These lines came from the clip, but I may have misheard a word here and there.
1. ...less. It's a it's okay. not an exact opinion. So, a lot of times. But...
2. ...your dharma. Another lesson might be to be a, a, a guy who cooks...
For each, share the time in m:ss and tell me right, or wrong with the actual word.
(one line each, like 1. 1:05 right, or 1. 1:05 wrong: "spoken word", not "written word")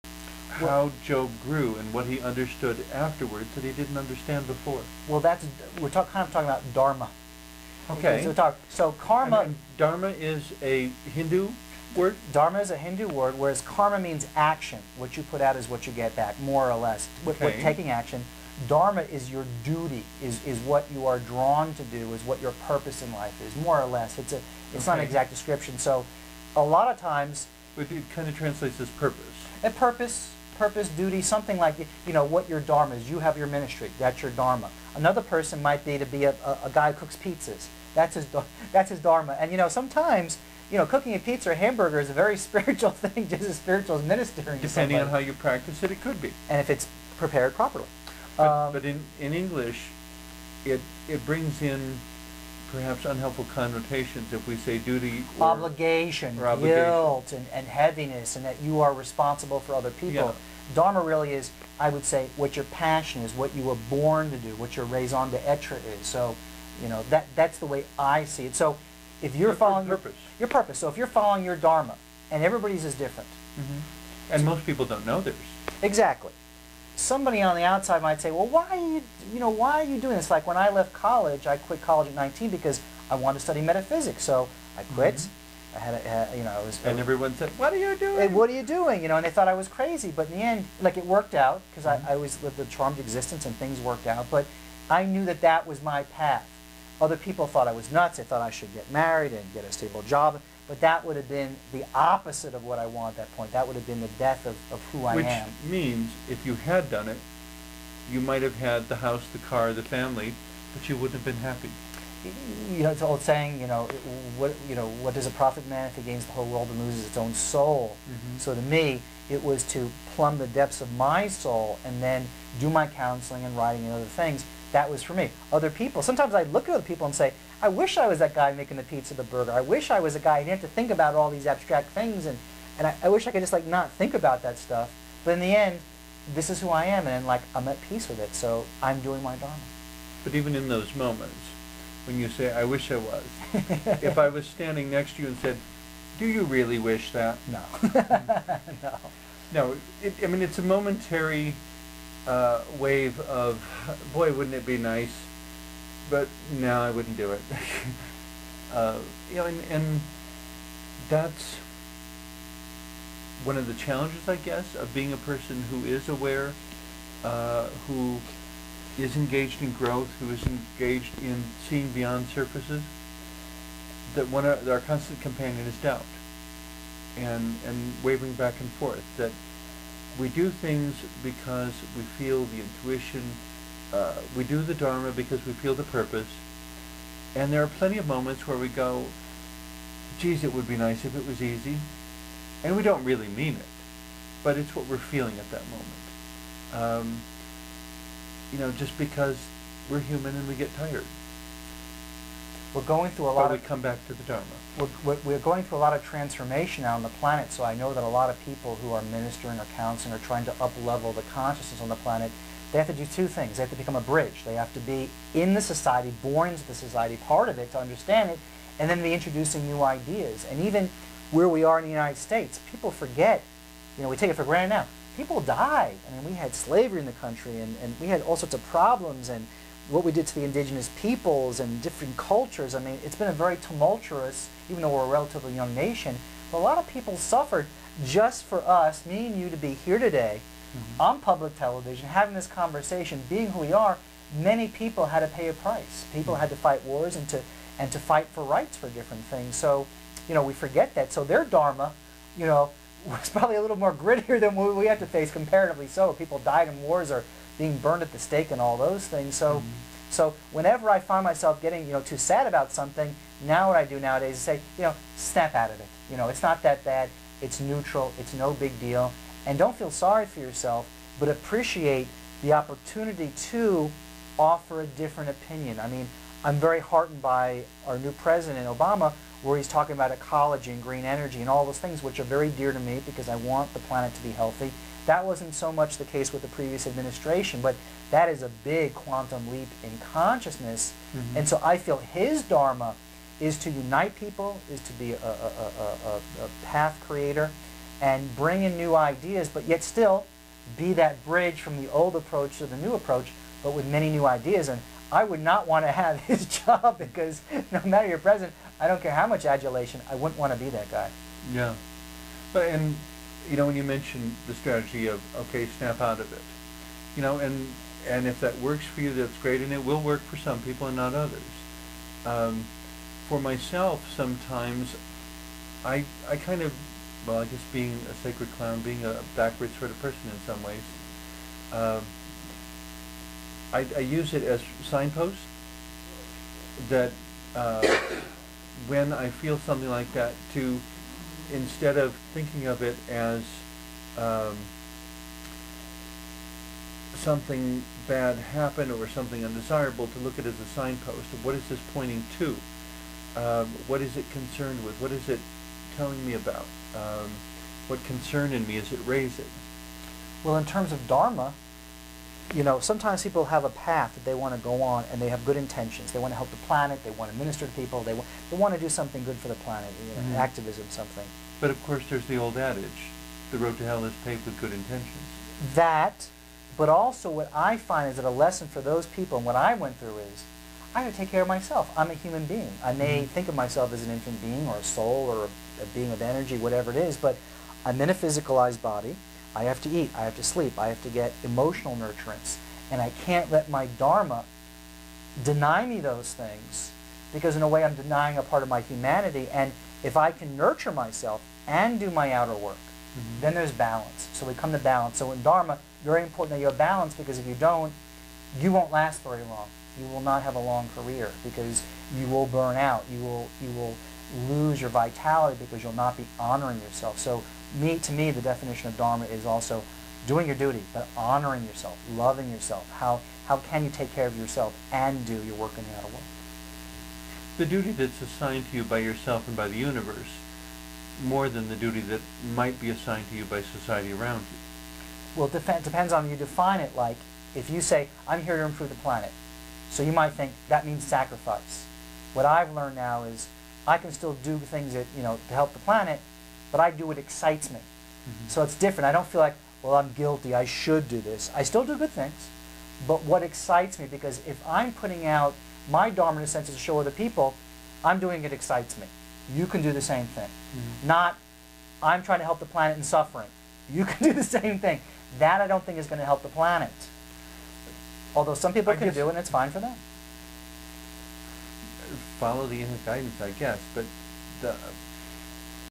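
1. 0:23 wrong: "description", not "opinion"
2. 0:34 wrong: "person", not "lesson".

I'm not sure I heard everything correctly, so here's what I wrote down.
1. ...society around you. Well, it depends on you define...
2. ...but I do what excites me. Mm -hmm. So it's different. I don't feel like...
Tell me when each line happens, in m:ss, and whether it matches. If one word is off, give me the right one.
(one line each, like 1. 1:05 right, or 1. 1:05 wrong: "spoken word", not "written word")
1. 7:13 right
2. 7:26 right.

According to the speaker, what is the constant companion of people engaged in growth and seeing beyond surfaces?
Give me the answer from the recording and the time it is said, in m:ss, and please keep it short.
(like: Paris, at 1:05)
doubt, at 2:55.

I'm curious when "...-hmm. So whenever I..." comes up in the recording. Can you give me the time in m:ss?
4:19.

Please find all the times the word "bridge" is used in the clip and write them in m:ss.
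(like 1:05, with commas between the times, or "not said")
3:34, 5:01.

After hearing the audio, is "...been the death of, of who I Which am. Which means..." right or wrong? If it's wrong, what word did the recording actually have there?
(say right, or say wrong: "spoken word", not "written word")
right.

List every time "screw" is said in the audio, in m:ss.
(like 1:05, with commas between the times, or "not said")
not said.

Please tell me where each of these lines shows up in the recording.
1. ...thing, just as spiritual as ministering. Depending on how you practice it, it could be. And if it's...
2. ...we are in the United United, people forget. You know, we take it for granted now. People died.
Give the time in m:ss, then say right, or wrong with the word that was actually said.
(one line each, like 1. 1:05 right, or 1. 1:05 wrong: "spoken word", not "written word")
1. 0:42 right
2. 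3:41 wrong: "States", not "United".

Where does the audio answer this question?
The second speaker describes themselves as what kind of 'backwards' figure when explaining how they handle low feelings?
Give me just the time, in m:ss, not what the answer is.
5:28.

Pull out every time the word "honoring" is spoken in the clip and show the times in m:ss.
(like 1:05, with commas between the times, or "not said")
6:56, 7:01.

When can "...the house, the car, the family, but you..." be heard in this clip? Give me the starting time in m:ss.
1:48.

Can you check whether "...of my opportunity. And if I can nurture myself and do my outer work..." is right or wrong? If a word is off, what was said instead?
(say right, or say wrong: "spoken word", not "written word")
wrong: "humanity", not "opportunity".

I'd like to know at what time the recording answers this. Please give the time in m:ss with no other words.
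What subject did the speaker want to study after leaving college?
1:23.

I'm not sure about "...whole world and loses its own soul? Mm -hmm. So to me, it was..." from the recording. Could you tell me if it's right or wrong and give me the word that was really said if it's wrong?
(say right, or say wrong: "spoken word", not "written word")
right.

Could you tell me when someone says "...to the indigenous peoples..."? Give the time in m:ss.
3:50.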